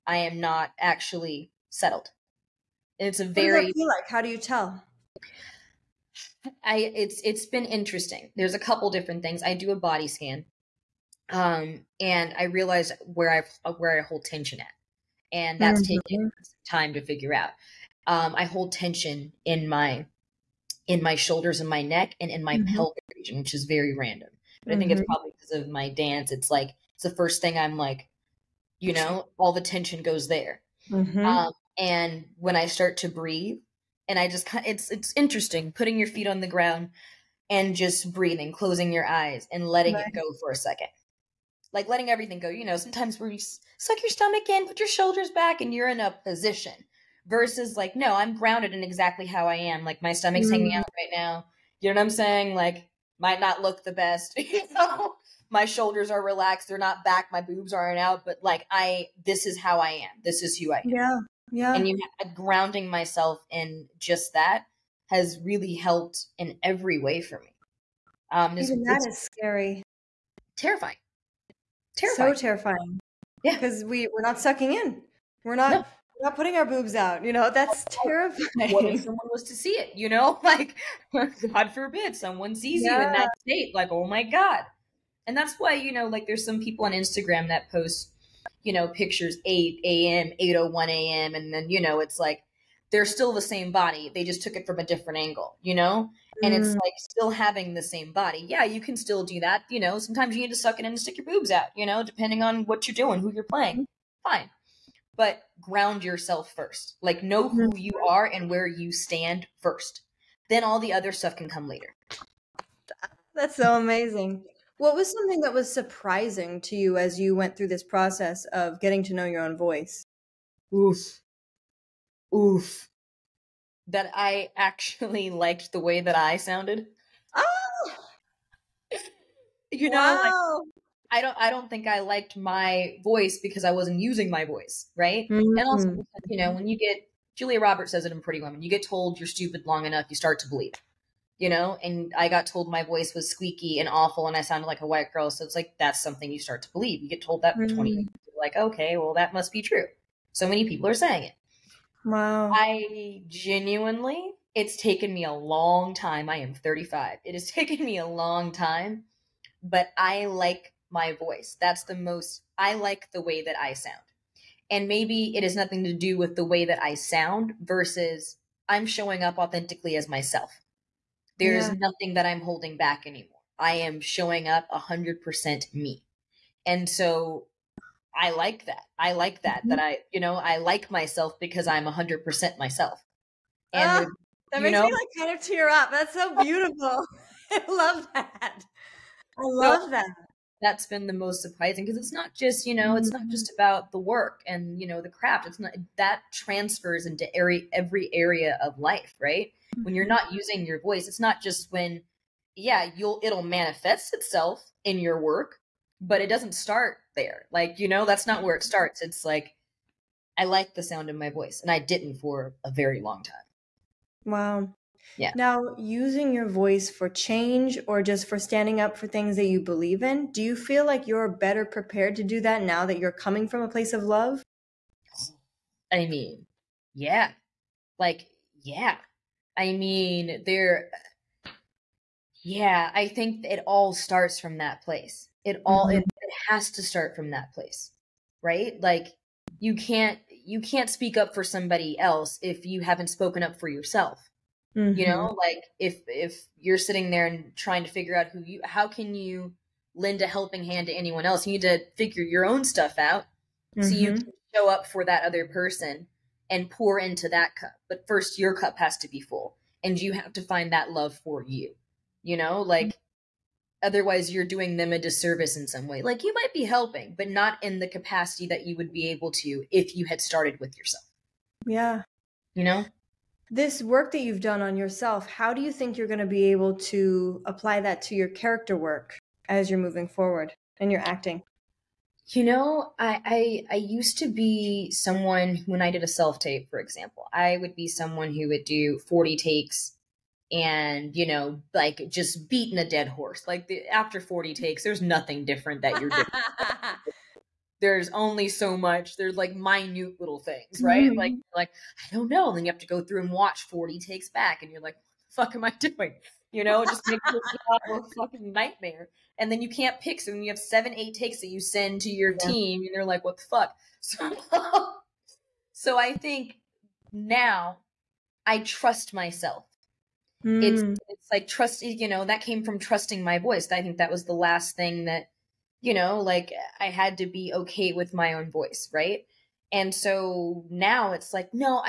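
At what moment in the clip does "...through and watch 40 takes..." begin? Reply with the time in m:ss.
5:02.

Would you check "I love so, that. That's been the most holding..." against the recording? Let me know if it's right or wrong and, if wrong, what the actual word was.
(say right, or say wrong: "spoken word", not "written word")
wrong: "surprising", not "holding".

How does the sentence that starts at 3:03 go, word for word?
And, ah, that makes know, me like kind of tear up.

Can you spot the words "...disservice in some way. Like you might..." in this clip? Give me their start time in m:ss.
4:24.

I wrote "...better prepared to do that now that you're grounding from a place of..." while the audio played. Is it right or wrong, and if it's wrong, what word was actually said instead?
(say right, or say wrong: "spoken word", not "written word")
wrong: "coming", not "grounding".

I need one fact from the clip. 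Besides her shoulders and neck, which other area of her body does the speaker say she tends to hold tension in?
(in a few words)
pelvic region.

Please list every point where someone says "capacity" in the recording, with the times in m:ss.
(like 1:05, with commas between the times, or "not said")
4:27.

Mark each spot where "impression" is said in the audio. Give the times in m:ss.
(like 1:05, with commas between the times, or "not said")
not said.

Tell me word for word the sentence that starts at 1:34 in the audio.
They just took it from a different angle, you know?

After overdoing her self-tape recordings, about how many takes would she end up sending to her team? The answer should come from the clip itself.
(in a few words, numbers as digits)
7 or 8 takes.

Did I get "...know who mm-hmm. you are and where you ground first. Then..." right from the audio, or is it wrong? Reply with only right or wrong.
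wrong.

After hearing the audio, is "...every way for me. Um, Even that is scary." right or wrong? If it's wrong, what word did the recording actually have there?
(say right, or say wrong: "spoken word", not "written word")
right.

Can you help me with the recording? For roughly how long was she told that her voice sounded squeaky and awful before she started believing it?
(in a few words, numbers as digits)
20 years.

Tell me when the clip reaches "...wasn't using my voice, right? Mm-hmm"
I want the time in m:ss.
2:13.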